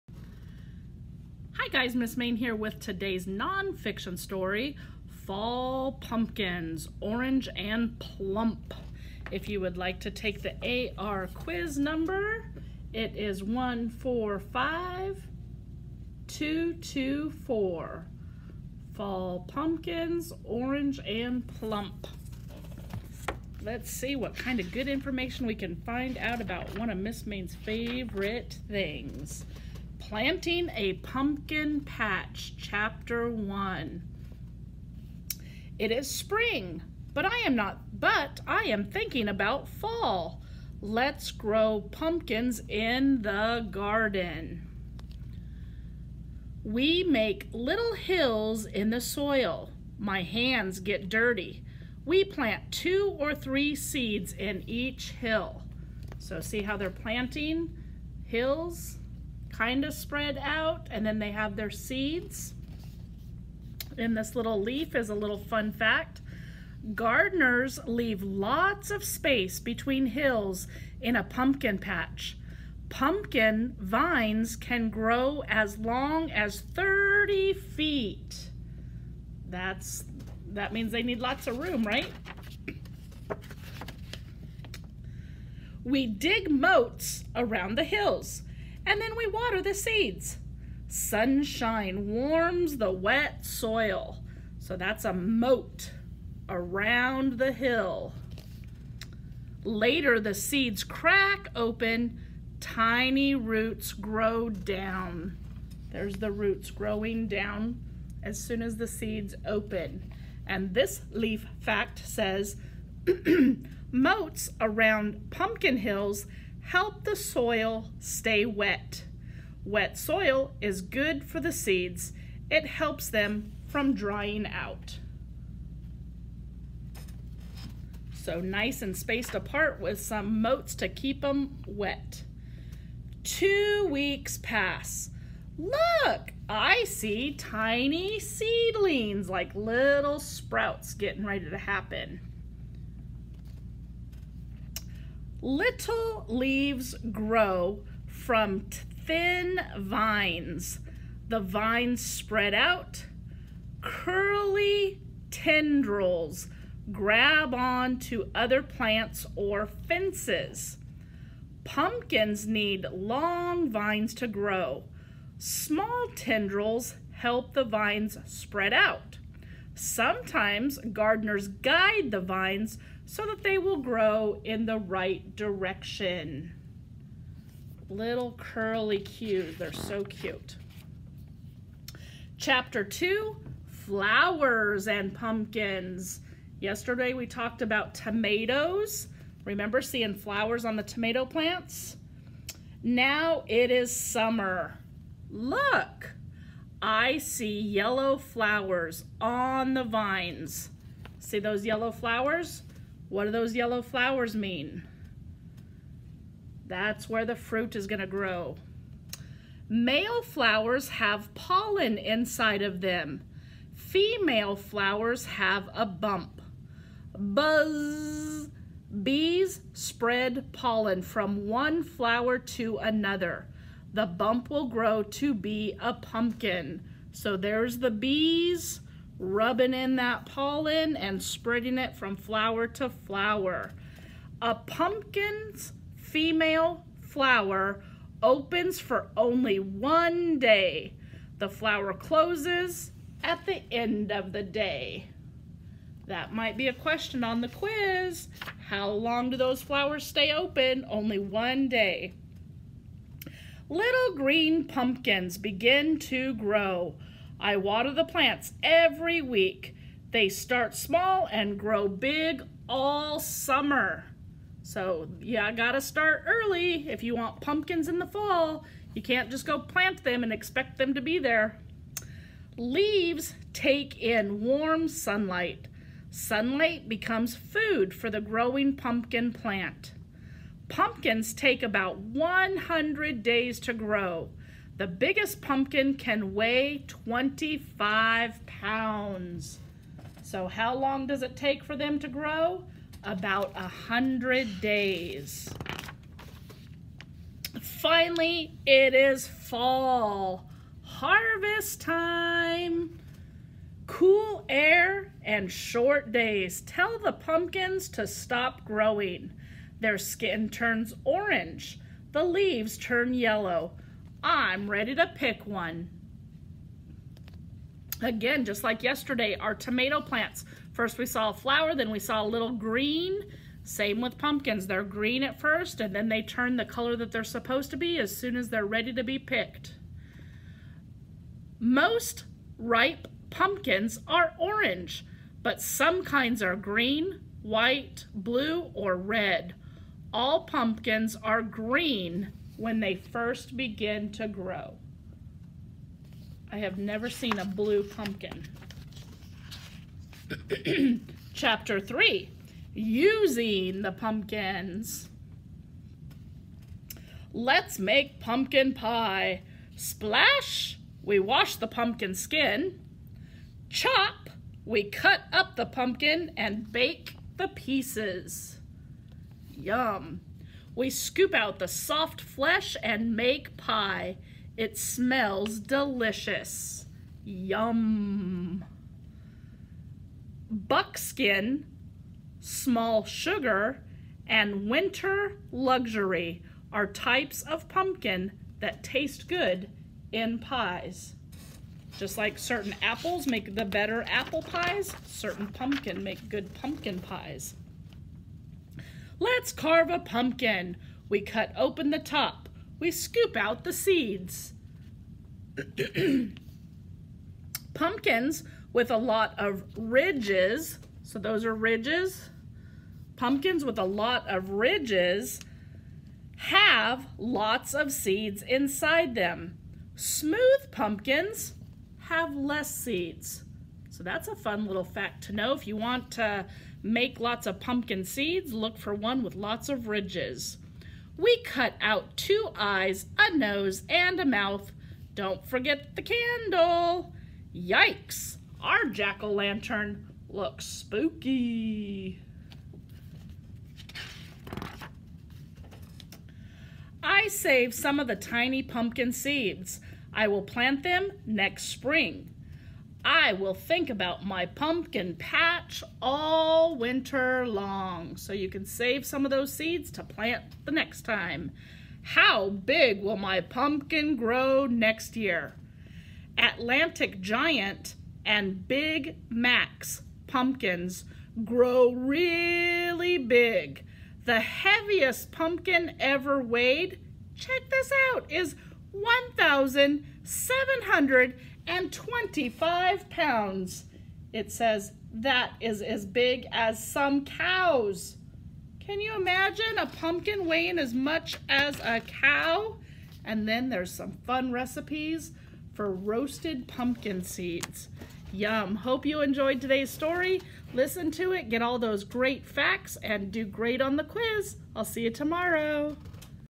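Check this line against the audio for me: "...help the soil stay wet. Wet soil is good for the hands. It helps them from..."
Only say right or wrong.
wrong.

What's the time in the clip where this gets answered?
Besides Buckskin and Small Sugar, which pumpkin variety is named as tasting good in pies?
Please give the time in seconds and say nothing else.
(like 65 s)
384 s.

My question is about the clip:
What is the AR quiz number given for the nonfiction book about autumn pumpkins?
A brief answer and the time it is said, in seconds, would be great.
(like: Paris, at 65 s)
145224, at 13 s.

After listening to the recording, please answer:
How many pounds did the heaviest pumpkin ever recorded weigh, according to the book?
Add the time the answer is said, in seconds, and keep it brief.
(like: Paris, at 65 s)
1,725 pounds, at 478 s.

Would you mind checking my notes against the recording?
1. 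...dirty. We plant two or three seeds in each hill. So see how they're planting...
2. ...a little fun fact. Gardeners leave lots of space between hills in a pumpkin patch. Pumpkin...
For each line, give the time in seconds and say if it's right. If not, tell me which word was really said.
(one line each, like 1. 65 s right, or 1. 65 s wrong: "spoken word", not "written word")
1. 51 s right
2. 65 s right.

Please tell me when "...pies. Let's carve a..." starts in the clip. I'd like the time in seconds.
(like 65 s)
396 s.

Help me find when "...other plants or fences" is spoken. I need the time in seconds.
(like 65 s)
158 s.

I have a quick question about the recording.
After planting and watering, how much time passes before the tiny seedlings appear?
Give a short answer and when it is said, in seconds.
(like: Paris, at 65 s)
Two weeks, at 133 s.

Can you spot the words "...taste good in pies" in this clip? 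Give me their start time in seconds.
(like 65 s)
388 s.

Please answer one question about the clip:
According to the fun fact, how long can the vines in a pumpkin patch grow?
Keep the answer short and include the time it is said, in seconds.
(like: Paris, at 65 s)
30 feet, at 76 s.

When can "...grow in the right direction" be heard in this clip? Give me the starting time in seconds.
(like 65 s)
173 s.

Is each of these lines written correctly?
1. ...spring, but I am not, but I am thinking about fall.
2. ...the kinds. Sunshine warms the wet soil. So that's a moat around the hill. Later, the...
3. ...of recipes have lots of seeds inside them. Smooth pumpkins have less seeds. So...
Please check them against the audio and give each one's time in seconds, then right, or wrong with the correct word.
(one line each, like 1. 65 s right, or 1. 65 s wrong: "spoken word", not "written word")
1. 36 s right
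2. 89 s wrong: "seeds", not "kinds"
3. 414 s wrong: "ridges", not "recipes".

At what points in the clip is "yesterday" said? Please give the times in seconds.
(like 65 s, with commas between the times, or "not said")
186 s, 318 s.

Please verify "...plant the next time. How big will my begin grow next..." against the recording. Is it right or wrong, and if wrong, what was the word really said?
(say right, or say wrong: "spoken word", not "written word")
wrong: "pumpkin", not "begin".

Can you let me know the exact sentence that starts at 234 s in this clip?
A pumpkin's female flower opens for only one day.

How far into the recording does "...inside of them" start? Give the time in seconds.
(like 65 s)
211 s.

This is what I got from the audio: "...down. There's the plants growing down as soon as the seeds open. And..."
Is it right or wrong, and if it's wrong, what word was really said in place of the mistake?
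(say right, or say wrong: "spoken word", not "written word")
wrong: "roots", not "plants".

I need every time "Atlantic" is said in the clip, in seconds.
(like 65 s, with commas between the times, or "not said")
466 s.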